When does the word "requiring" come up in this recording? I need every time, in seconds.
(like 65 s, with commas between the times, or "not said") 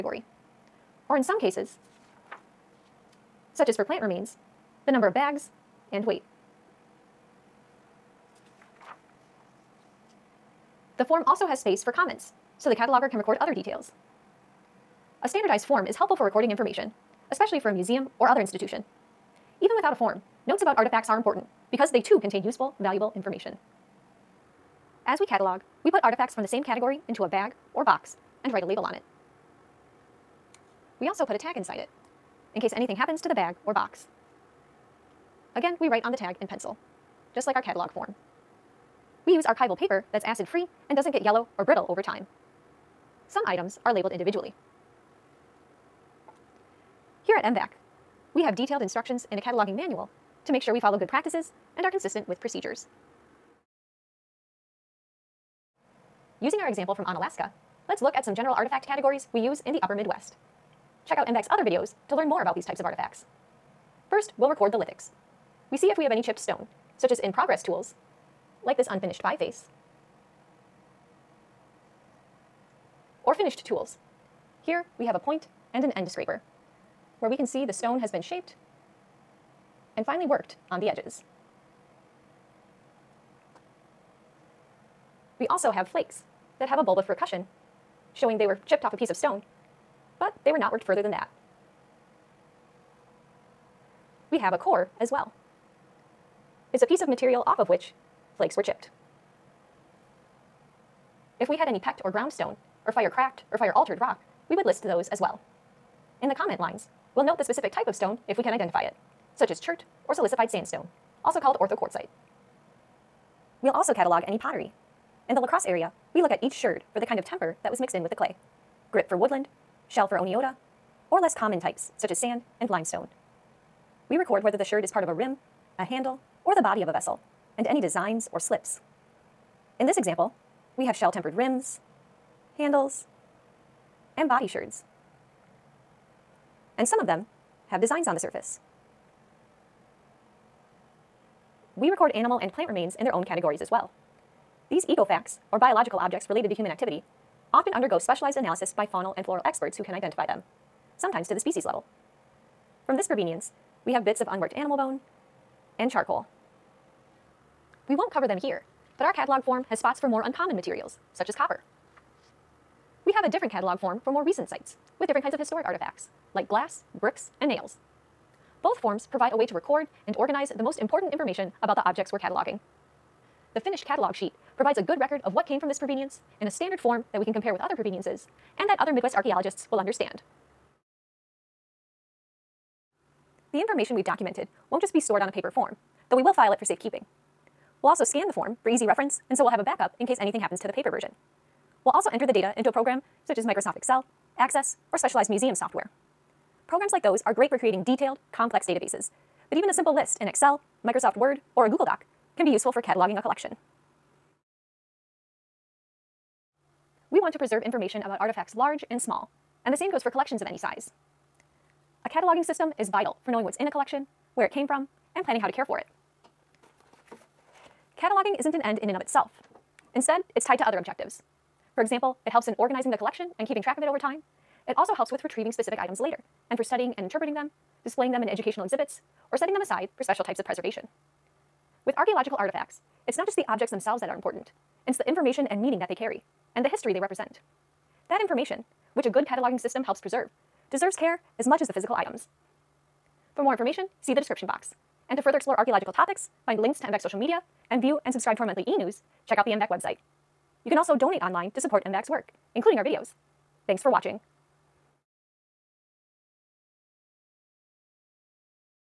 not said.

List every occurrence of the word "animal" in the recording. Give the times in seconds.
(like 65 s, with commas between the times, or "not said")
142 s, 154 s.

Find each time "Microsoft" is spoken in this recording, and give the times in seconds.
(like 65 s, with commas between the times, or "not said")
193 s, 200 s.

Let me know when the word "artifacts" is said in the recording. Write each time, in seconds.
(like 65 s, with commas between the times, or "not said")
20 s, 26 s, 58 s, 62 s, 165 s, 208 s, 232 s.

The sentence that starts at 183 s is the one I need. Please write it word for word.
The information we've documented won't just be stored on a paper form, though we will file it for safekeeping.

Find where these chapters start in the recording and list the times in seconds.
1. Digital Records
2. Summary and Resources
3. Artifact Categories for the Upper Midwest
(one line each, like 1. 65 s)
1. 181 s
2. 204 s
3. 54 s.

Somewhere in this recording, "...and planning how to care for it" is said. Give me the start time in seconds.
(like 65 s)
215 s.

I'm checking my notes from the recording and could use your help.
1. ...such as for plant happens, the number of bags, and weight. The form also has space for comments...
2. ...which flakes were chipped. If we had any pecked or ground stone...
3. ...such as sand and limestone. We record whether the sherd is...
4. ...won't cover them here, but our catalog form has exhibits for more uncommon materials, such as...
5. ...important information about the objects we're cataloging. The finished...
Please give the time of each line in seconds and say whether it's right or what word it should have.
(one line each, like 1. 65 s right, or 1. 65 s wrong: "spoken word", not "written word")
1. 3 s wrong: "remains", not "happens"
2. 97 s right
3. 121 s right
4. 157 s wrong: "spots", not "exhibits"
5. 170 s right.